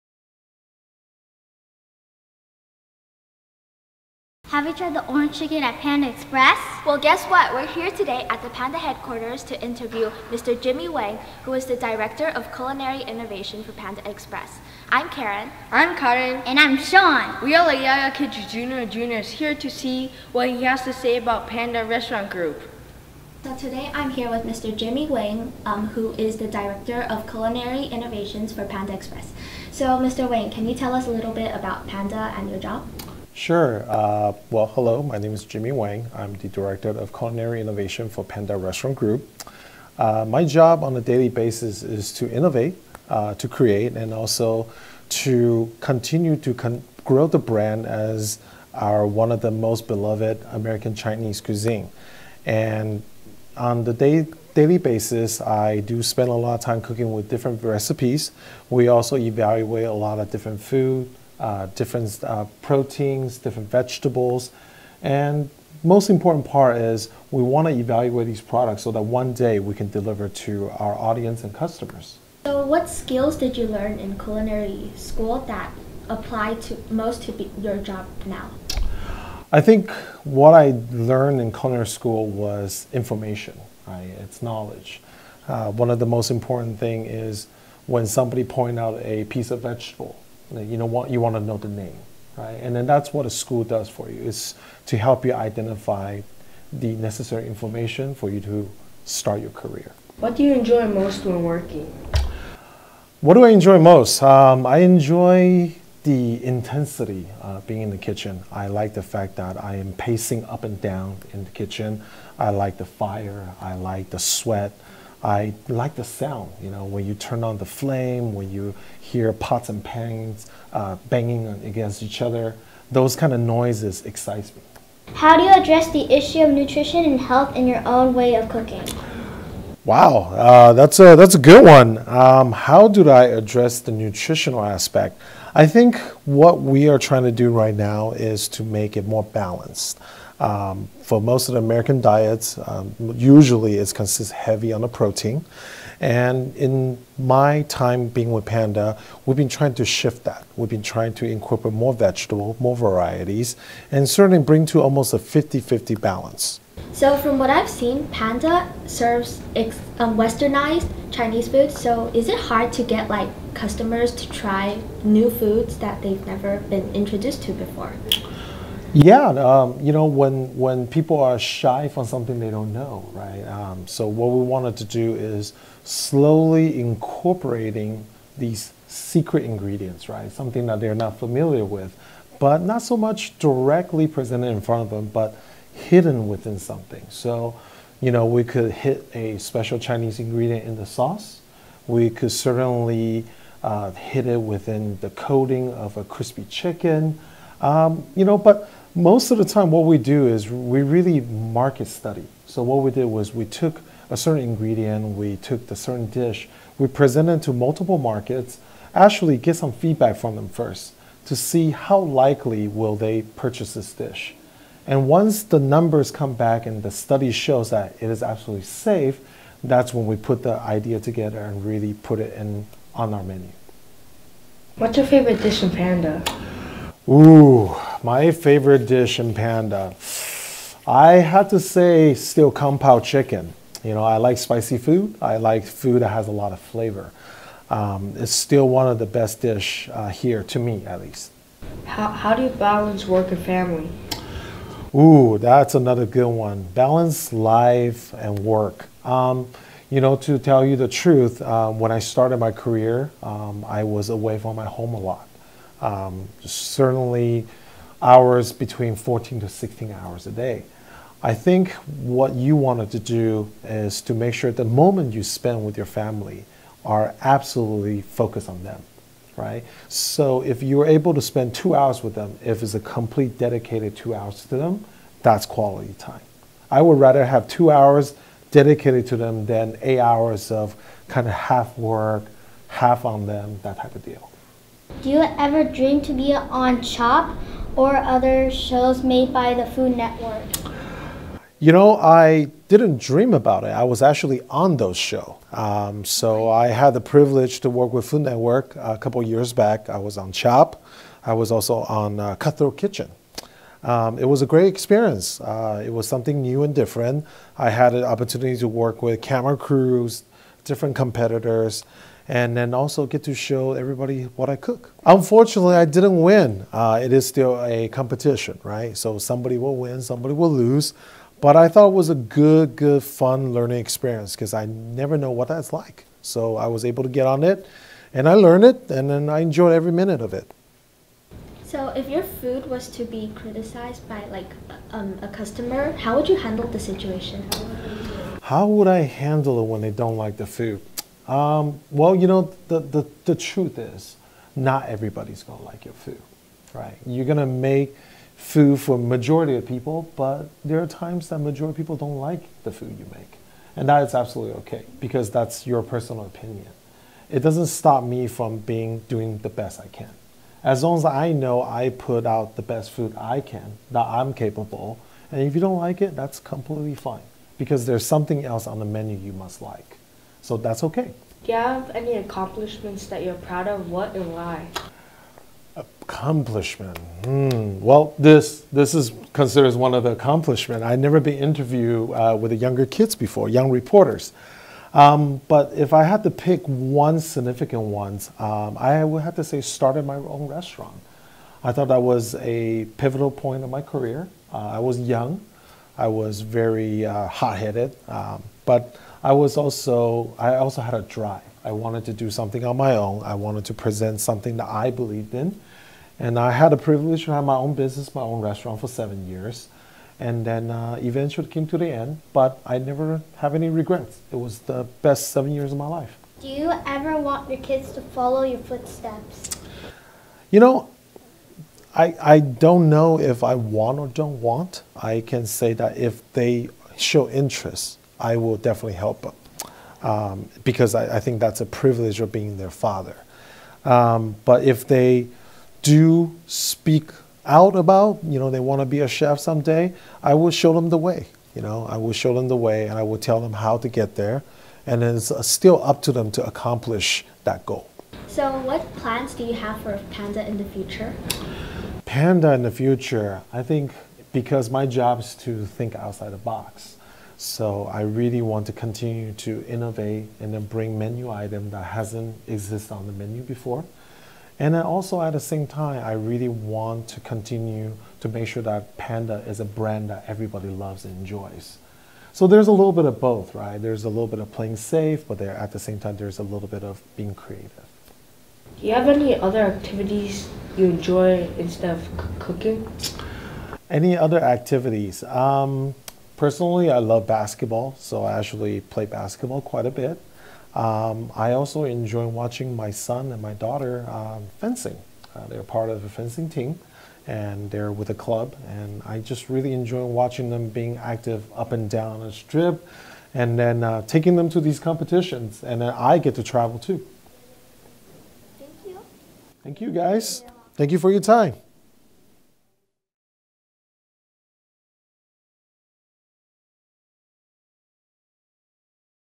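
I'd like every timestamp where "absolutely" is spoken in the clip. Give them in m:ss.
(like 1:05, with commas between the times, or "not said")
3:38, 4:27, 5:54.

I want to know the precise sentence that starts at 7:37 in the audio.
So I really want to continue to innovate and then bring menu item that hasn't existed on the menu before.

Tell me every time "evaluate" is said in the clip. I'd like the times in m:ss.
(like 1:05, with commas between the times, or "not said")
0:59, 1:07.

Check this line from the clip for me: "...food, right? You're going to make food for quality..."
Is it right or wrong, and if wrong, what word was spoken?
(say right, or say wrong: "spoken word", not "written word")
wrong: "majority", not "quality".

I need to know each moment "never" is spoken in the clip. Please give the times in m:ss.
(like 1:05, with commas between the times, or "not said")
2:46, 5:24, 6:20, 6:52.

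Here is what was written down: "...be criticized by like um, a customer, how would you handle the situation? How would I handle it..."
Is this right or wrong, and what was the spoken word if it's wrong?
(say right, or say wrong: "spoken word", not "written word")
right.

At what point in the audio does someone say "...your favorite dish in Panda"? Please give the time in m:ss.
3:44.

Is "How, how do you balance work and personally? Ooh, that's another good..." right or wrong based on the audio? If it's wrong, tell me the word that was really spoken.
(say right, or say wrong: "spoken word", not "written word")
wrong: "family", not "personally".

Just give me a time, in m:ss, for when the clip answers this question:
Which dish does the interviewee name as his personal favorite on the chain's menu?
3:52.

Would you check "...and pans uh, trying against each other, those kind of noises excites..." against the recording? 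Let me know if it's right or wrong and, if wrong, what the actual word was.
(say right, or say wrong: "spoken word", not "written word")
wrong: "banging", not "trying".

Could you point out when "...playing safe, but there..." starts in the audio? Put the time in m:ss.
7:54.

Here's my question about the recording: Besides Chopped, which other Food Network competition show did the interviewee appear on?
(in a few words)
Cutthroat Kitchen.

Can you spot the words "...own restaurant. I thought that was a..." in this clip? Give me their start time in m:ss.
6:30.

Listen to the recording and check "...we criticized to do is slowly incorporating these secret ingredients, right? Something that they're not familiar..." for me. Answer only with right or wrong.
wrong.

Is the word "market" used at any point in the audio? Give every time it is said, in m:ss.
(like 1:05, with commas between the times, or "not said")
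3:21, 3:27.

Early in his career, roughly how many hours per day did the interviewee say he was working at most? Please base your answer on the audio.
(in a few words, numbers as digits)
16.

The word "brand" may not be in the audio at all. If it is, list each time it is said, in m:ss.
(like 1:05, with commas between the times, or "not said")
0:47, 7:49.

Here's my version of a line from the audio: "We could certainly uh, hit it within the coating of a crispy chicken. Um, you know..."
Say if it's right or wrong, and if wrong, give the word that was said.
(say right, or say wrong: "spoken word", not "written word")
right.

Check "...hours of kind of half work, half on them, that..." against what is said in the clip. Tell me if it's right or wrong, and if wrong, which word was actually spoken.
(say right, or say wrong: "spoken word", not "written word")
right.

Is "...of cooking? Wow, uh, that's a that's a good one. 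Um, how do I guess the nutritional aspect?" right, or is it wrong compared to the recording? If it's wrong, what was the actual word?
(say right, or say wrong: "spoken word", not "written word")
wrong: "address", not "guess".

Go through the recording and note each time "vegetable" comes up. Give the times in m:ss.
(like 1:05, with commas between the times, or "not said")
1:03, 1:29, 2:31.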